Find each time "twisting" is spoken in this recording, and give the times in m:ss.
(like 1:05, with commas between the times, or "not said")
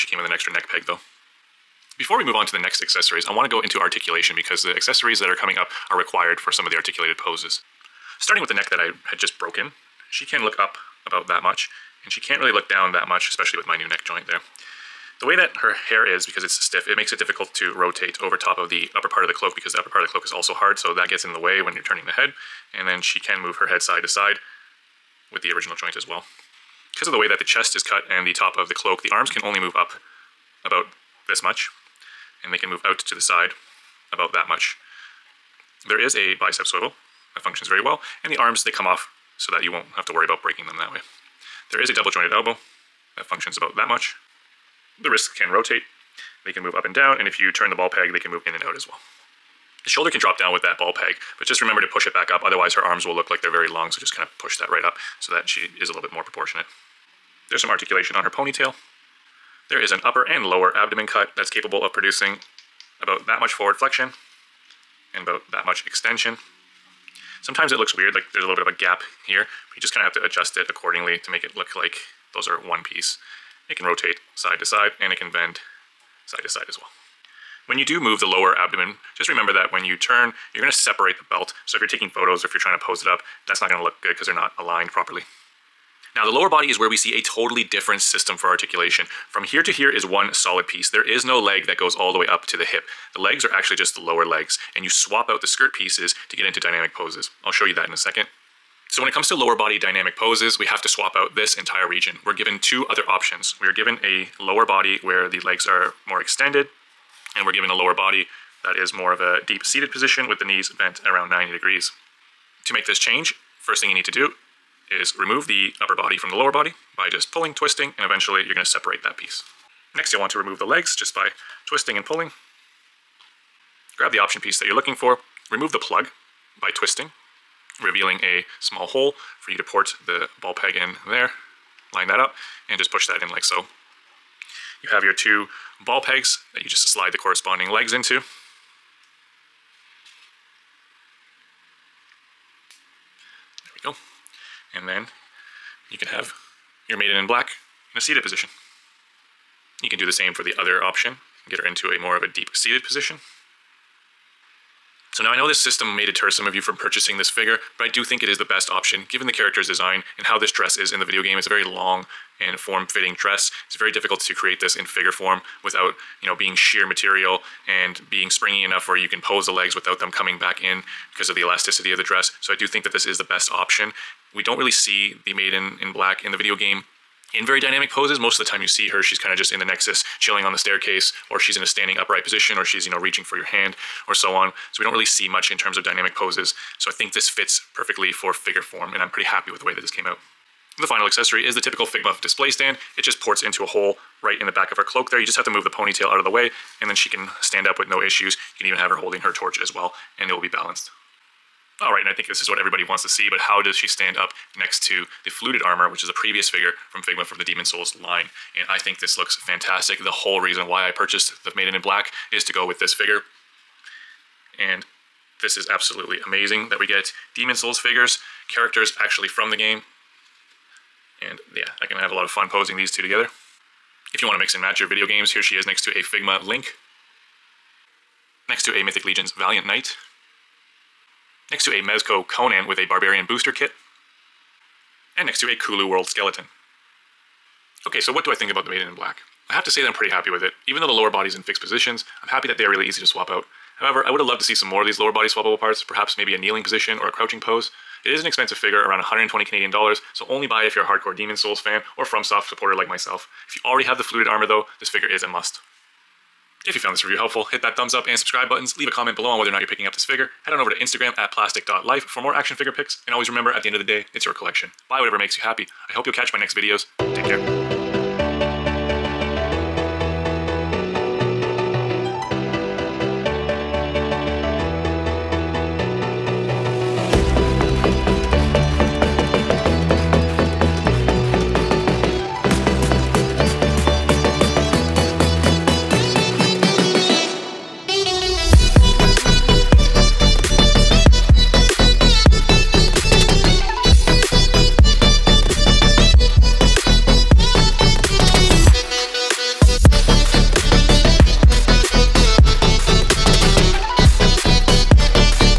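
1:57, 2:01, 2:06.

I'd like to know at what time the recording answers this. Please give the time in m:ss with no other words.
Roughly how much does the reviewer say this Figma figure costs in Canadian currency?
4:08.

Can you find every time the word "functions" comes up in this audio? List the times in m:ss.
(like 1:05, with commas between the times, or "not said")
0:37, 0:43.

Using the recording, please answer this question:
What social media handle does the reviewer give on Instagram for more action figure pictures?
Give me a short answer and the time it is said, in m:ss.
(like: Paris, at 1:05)
plastic.lyfe, at 4:21.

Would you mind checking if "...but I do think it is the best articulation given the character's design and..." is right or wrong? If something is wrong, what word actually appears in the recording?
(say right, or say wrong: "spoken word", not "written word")
wrong: "option", not "articulation".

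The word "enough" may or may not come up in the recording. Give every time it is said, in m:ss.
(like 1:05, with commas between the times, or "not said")
2:48.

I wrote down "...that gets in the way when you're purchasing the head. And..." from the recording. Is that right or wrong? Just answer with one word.
wrong.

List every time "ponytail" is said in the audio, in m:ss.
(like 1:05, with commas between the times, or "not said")
0:58, 3:15.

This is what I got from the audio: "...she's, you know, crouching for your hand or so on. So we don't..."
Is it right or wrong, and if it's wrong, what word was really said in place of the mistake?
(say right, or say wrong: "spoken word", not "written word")
wrong: "reaching", not "crouching".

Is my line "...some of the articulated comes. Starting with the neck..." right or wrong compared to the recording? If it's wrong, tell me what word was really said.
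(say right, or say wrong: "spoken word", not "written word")
wrong: "poses", not "comes".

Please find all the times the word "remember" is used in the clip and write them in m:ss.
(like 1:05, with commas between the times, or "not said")
0:51, 1:19, 4:23.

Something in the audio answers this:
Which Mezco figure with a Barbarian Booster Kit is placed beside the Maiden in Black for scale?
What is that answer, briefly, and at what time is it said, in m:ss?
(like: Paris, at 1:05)
Conan, at 3:52.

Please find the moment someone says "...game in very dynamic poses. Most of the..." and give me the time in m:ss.
2:56.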